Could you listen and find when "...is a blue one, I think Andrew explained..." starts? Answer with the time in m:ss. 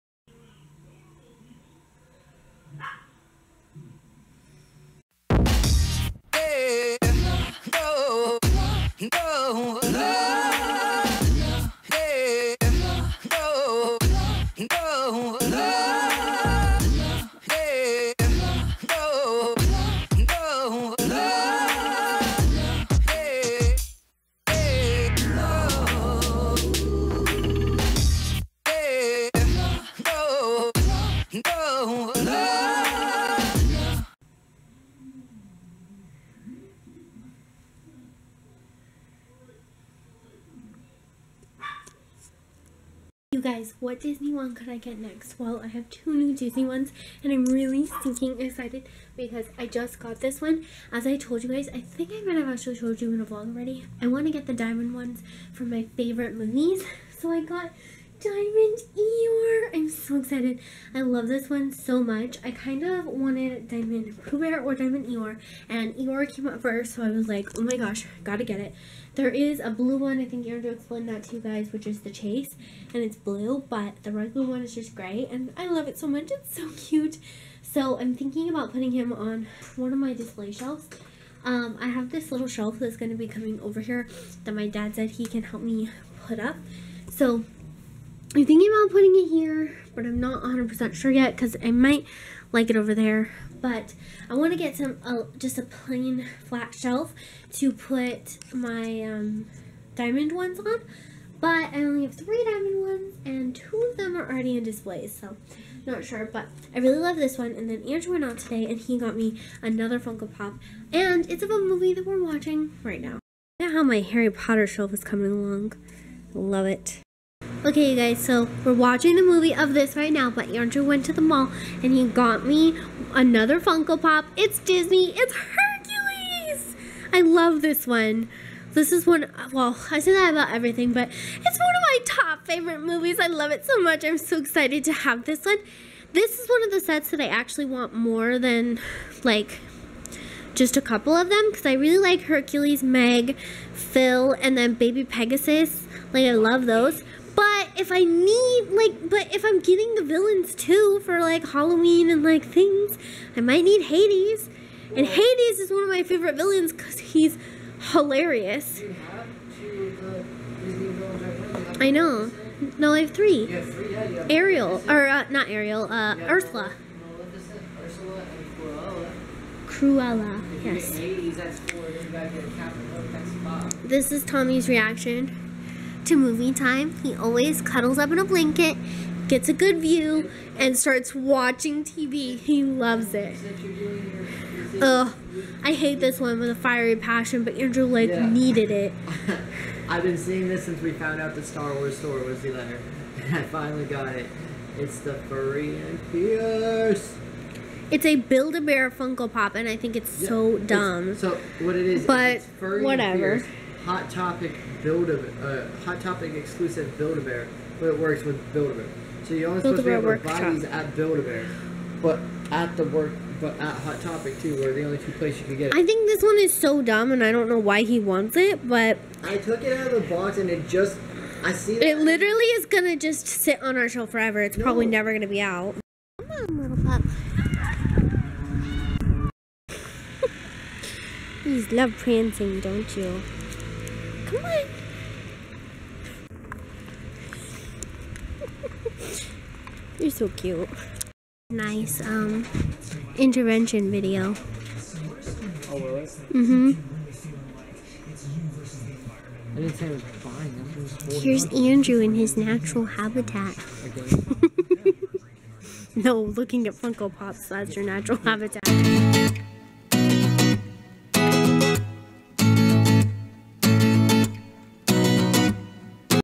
1:09.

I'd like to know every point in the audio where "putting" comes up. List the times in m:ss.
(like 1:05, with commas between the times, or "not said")
1:18, 1:28.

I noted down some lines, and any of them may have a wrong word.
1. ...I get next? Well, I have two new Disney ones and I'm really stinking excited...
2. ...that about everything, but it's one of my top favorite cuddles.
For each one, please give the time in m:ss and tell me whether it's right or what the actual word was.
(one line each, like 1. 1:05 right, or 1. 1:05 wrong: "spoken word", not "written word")
1. 0:44 right
2. 2:10 wrong: "movies", not "cuddles".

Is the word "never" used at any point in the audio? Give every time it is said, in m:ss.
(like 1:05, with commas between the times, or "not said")
3:44.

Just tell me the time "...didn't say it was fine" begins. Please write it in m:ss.
4:09.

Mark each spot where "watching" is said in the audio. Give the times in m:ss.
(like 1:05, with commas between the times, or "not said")
1:52, 1:58, 3:01.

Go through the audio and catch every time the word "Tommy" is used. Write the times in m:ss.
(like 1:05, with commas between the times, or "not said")
2:54.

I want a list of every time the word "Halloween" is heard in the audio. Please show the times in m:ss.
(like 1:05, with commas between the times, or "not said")
2:31.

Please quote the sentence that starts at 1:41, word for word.
But I only have three diamond ones and two of them are already in displays.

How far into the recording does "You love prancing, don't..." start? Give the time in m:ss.
3:51.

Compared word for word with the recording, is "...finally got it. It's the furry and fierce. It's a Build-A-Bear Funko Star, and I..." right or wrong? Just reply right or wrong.
wrong.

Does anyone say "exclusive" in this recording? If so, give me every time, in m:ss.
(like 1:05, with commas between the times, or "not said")
3:26.